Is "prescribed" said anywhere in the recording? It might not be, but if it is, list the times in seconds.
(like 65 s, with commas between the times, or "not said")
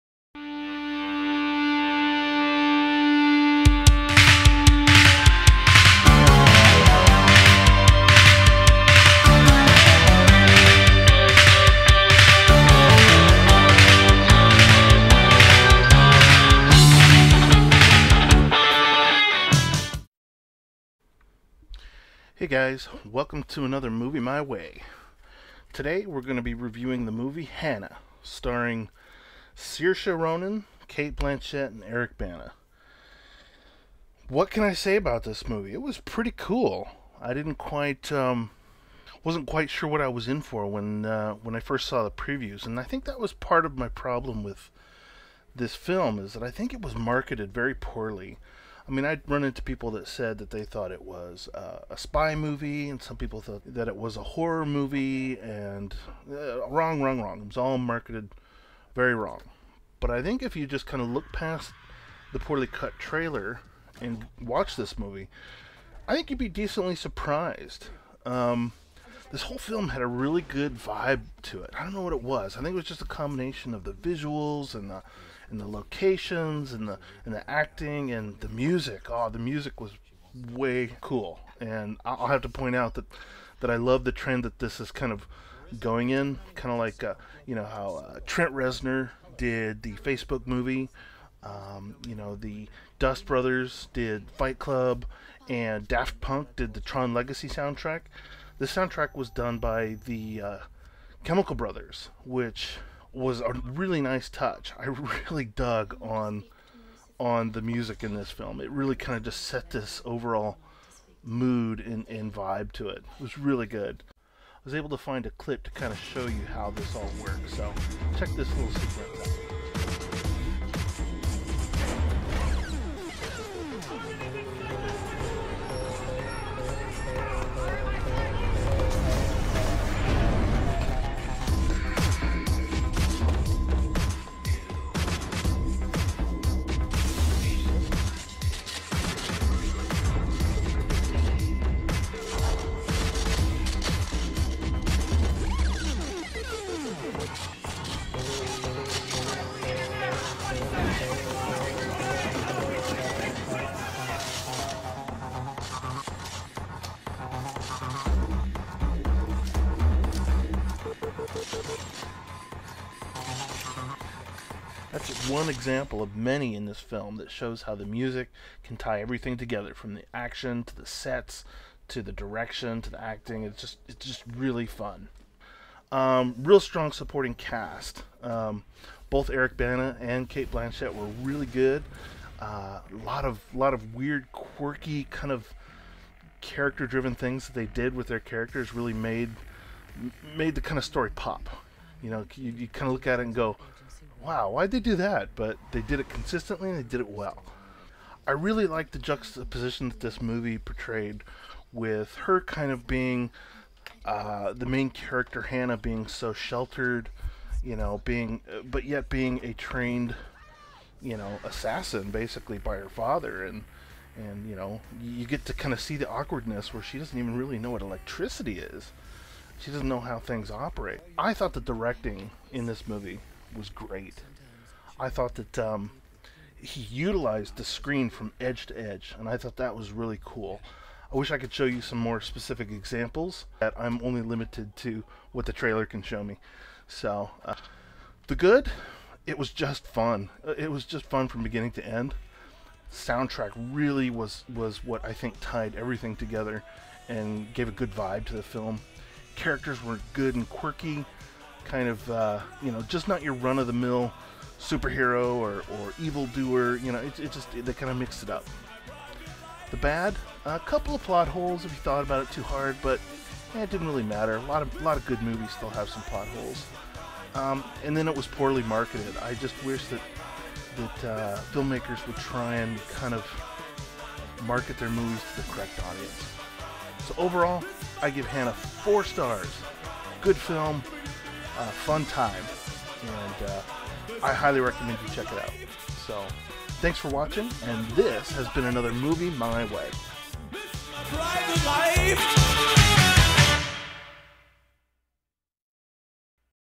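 not said.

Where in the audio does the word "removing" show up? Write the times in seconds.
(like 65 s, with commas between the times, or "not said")
not said.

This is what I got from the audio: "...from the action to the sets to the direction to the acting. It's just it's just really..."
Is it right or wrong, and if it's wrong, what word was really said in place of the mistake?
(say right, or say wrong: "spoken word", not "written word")
right.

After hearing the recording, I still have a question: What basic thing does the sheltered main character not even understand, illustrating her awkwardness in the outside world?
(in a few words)
electricity.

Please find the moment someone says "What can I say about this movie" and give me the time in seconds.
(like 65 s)
34 s.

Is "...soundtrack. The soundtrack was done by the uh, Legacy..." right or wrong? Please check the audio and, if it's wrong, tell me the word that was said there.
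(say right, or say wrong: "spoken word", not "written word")
wrong: "Chemical", not "Legacy".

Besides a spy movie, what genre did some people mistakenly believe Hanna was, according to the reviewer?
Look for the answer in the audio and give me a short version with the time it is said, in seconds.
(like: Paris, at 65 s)
horror movie, at 54 s.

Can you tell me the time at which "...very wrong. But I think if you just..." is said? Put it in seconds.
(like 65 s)
58 s.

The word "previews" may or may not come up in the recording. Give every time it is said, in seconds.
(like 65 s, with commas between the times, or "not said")
42 s.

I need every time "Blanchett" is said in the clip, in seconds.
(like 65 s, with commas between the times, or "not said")
31 s, 180 s.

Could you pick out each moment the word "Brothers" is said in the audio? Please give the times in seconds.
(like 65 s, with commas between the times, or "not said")
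93 s, 101 s.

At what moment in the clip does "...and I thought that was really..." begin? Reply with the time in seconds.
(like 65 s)
229 s.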